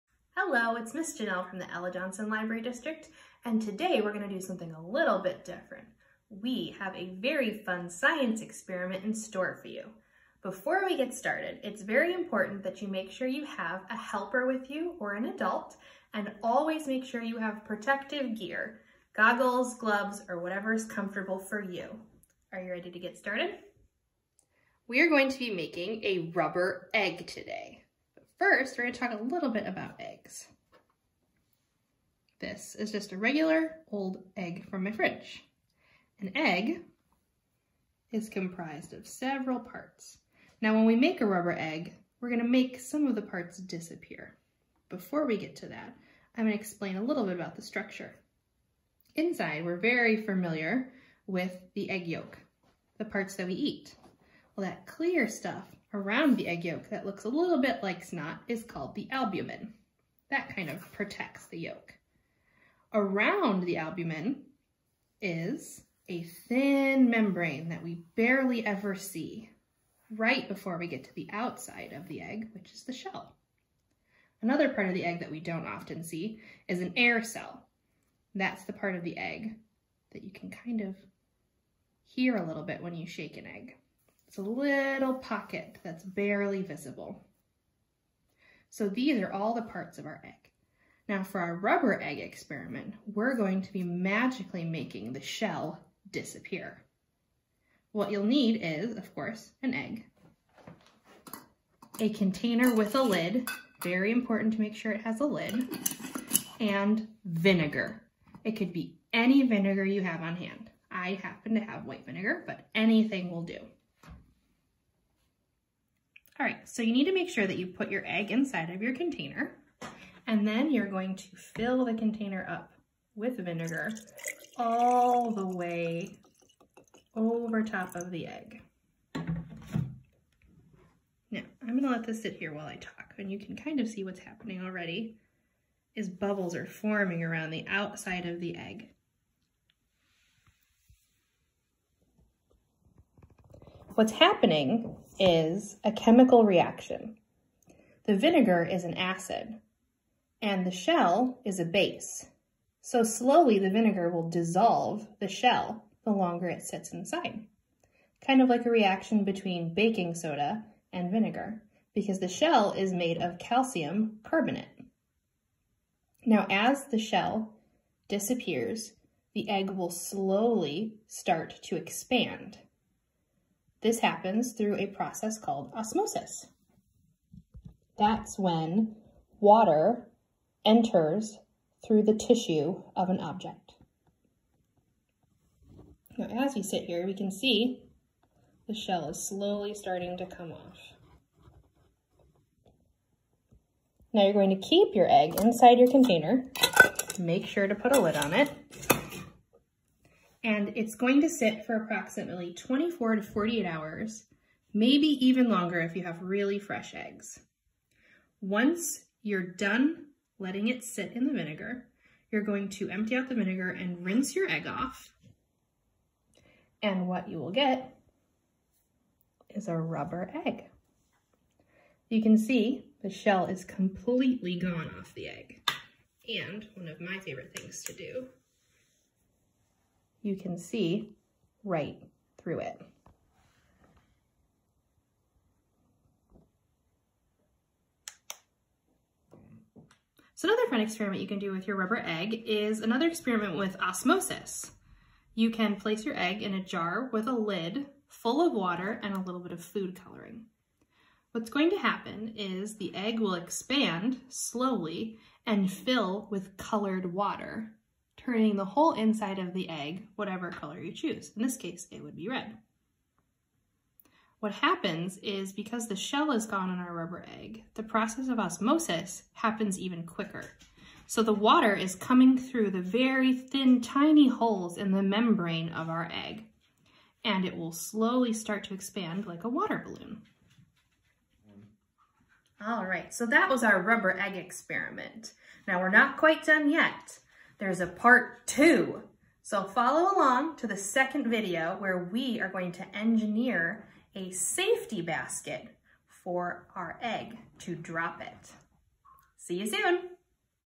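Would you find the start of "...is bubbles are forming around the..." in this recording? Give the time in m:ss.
2:15.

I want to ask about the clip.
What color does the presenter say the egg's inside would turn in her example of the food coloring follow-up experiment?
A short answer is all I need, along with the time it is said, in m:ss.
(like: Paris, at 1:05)
red, at 4:22.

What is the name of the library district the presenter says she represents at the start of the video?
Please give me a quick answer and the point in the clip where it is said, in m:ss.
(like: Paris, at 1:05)
Ella Johnson Library District, at 0:01.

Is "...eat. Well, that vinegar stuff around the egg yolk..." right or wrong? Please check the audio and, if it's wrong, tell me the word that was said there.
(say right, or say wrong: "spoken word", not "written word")
wrong: "clear", not "vinegar".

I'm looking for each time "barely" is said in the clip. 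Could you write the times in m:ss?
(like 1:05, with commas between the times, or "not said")
1:08, 1:26.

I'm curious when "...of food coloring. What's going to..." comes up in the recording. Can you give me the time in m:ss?
4:09.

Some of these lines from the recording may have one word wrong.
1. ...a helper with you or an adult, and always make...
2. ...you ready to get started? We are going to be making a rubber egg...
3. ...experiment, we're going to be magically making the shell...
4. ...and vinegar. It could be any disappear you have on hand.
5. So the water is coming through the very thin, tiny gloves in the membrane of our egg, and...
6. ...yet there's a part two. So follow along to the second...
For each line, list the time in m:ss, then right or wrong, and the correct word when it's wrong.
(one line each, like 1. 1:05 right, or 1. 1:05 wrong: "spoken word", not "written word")
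1. 0:13 right
2. 0:22 right
3. 1:32 right
4. 1:46 wrong: "vinegar", not "disappear"
5. 4:31 wrong: "holes", not "gloves"
6. 4:46 right.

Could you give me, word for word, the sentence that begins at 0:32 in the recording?
This is just a regular old egg from my fridge.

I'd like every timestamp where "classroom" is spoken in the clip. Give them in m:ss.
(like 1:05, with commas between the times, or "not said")
not said.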